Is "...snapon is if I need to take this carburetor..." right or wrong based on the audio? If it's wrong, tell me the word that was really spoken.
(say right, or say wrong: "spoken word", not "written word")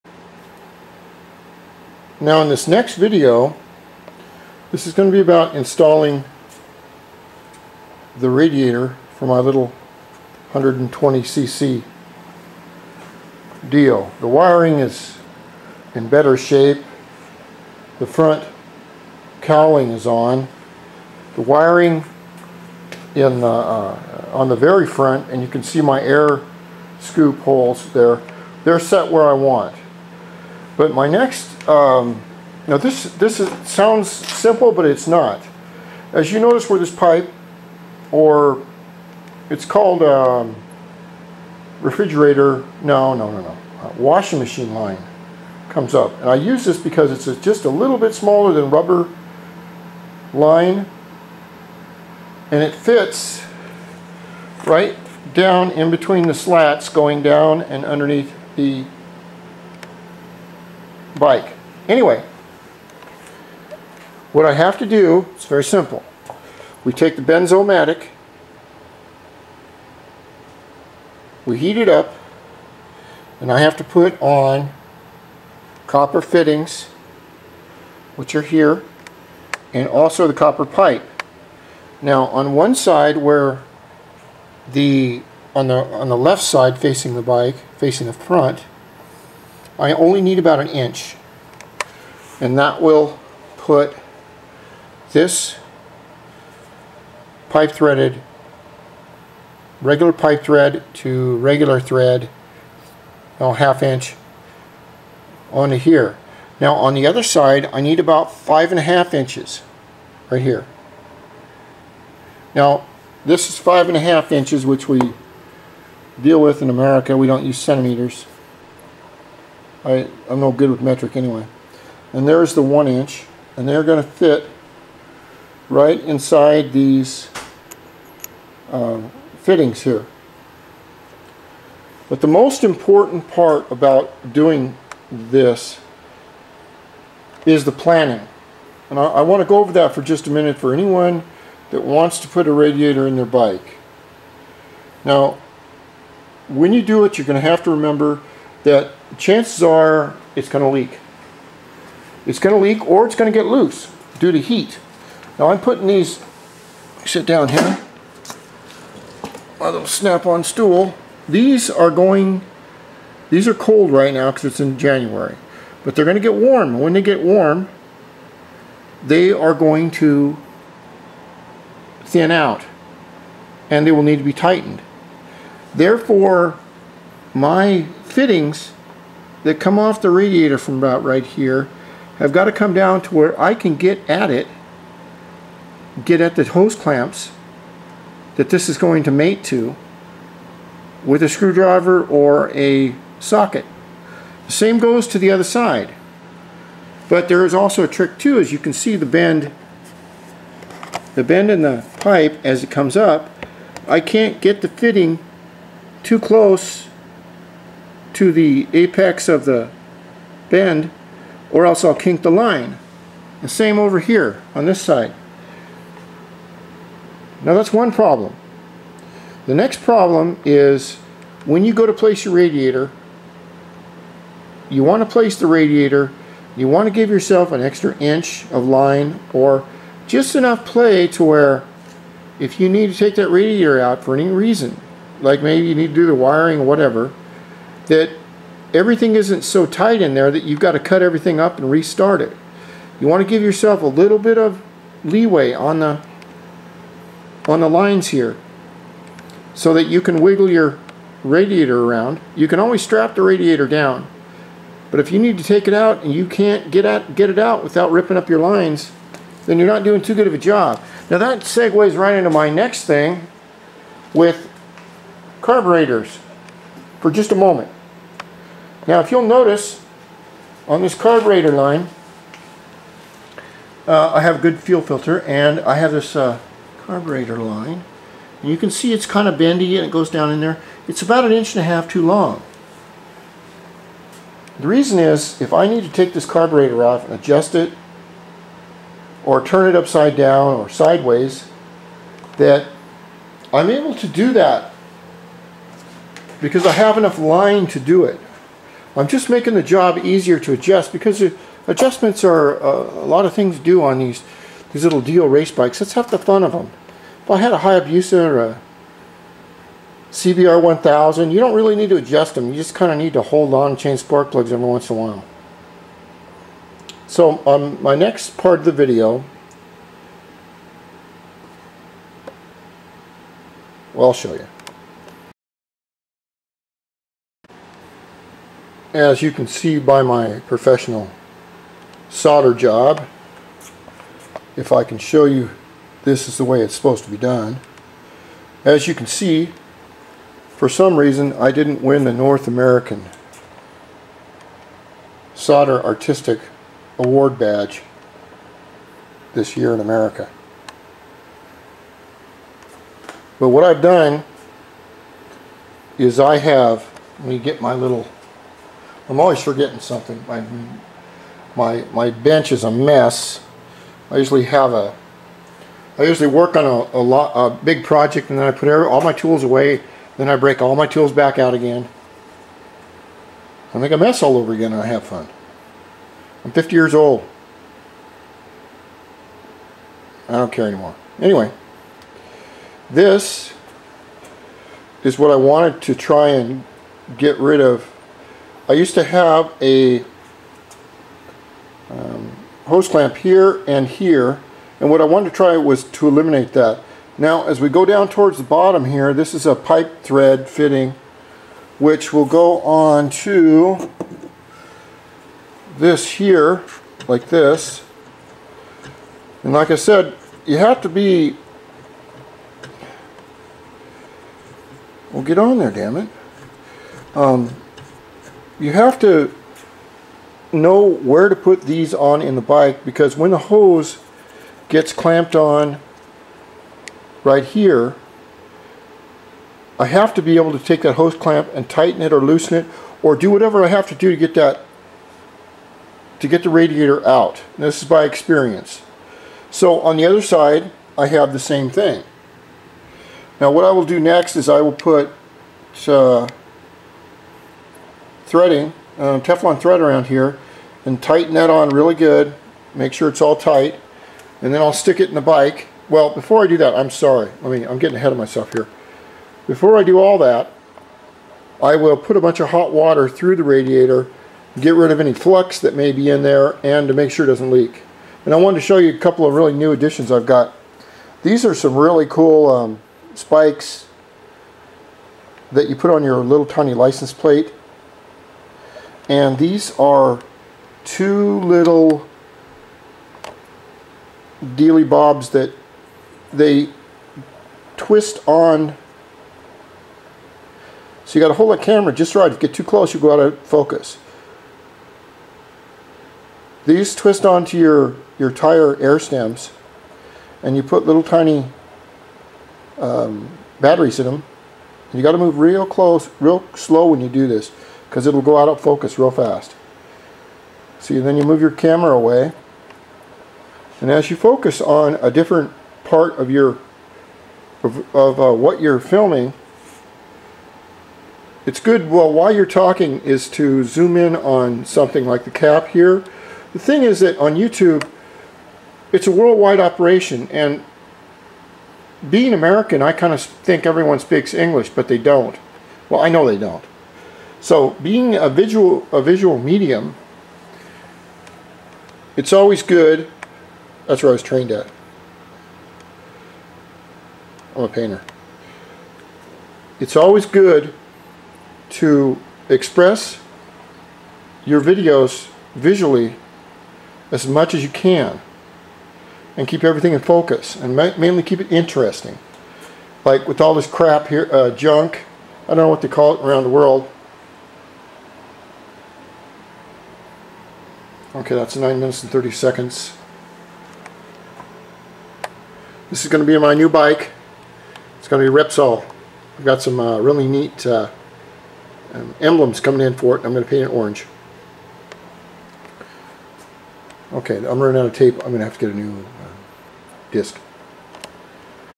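wrong: "reason", not "snapon".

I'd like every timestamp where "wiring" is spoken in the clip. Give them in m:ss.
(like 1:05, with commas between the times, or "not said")
0:14, 0:21, 3:56.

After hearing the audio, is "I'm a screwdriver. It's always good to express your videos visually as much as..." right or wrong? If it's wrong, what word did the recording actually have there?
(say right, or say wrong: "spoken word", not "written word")
wrong: "painter", not "screwdriver".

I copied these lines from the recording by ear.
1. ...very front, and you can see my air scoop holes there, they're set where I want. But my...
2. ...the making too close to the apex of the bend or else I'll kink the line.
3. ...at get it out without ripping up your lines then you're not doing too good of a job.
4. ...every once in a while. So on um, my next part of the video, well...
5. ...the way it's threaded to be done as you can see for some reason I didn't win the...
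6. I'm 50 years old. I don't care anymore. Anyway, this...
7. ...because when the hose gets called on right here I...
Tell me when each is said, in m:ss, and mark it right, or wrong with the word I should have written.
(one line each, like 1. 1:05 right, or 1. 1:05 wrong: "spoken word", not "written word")
1. 0:24 right
2. 3:24 wrong: "fitting", not "making"
3. 4:16 right
4. 5:14 right
5. 5:36 wrong: "supposed", not "threaded"
6. 6:16 right
7. 7:02 wrong: "clamped", not "called".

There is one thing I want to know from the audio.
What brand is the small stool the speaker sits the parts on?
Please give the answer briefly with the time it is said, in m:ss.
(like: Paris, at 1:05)
Snap-on, at 2:39.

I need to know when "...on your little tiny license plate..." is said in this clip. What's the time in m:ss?
7:55.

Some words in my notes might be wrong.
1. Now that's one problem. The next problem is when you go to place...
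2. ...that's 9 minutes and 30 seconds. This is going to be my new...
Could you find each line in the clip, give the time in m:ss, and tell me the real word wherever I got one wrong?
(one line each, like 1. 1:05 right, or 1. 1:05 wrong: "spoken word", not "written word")
1. 3:37 right
2. 9:31 right.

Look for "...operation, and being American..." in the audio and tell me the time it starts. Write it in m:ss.
8:49.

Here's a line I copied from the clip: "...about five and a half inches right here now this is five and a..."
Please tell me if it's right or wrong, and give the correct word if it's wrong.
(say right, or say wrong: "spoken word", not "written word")
right.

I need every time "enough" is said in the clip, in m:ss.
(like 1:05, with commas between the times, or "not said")
3:50, 4:56.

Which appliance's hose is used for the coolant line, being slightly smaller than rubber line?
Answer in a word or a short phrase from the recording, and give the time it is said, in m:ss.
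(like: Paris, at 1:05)
washing machine line, at 0:43.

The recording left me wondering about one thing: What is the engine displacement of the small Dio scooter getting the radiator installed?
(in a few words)
120cc.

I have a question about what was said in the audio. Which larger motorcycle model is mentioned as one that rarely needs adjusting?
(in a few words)
CBR 1000.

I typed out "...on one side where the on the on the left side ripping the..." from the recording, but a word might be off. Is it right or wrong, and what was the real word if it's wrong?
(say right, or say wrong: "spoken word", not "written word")
wrong: "facing", not "ripping".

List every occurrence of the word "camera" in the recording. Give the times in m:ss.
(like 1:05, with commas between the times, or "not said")
8:11, 8:31.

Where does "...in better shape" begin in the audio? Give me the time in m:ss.
0:15.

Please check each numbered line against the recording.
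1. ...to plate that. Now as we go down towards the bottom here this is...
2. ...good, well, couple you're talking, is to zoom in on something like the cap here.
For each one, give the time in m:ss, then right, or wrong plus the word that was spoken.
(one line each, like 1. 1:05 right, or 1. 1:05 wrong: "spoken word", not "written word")
1. 6:35 wrong: "eliminate", not "plate"
2. 8:41 wrong: "while", not "couple".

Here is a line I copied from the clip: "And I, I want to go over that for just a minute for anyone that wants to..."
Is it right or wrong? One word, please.
right.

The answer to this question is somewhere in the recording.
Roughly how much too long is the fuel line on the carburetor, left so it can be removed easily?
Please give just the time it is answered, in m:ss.
4:41.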